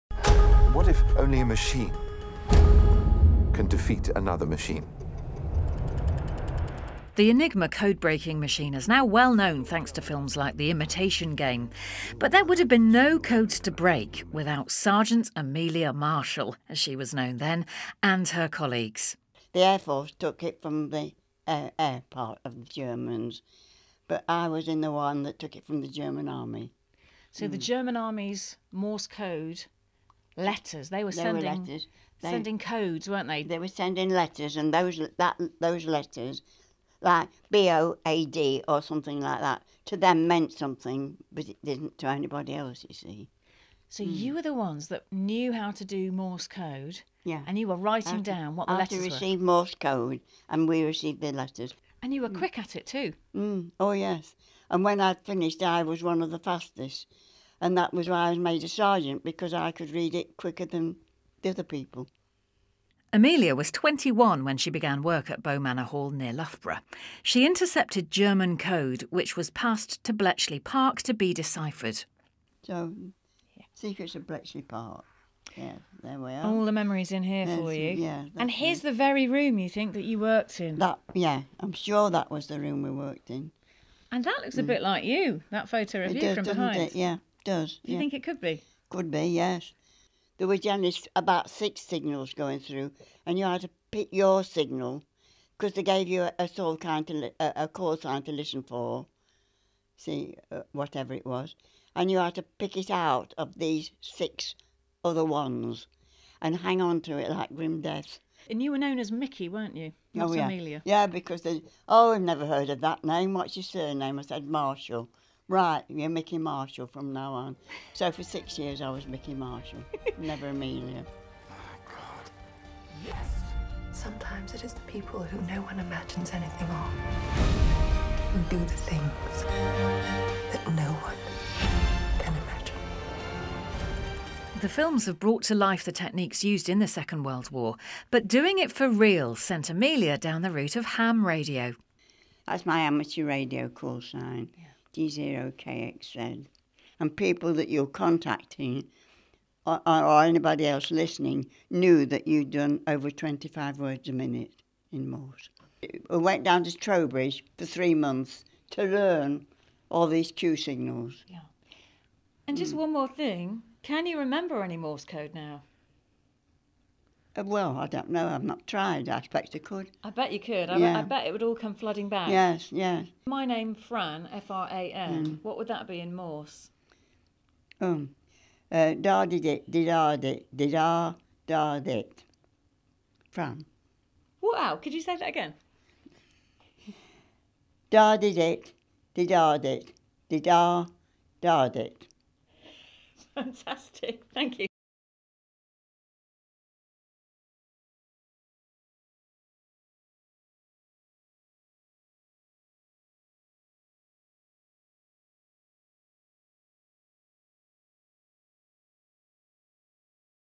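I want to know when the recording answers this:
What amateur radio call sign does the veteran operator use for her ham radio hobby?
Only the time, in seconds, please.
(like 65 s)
144 s.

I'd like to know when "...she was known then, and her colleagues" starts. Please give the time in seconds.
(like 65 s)
16 s.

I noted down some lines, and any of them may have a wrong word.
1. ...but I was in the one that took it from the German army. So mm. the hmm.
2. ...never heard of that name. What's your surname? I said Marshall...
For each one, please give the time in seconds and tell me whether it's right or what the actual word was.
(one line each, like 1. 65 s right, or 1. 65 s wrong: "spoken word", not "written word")
1. 24 s right
2. 112 s right.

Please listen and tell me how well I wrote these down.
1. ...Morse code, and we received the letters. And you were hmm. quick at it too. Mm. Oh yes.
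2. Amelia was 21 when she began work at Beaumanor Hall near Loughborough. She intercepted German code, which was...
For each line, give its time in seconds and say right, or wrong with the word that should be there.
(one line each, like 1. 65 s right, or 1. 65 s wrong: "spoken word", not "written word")
1. 49 s right
2. 63 s right.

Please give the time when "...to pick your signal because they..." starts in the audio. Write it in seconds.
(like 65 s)
93 s.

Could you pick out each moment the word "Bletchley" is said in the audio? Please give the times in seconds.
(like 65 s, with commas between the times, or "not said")
70 s, 74 s.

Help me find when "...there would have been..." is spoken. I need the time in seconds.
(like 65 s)
12 s.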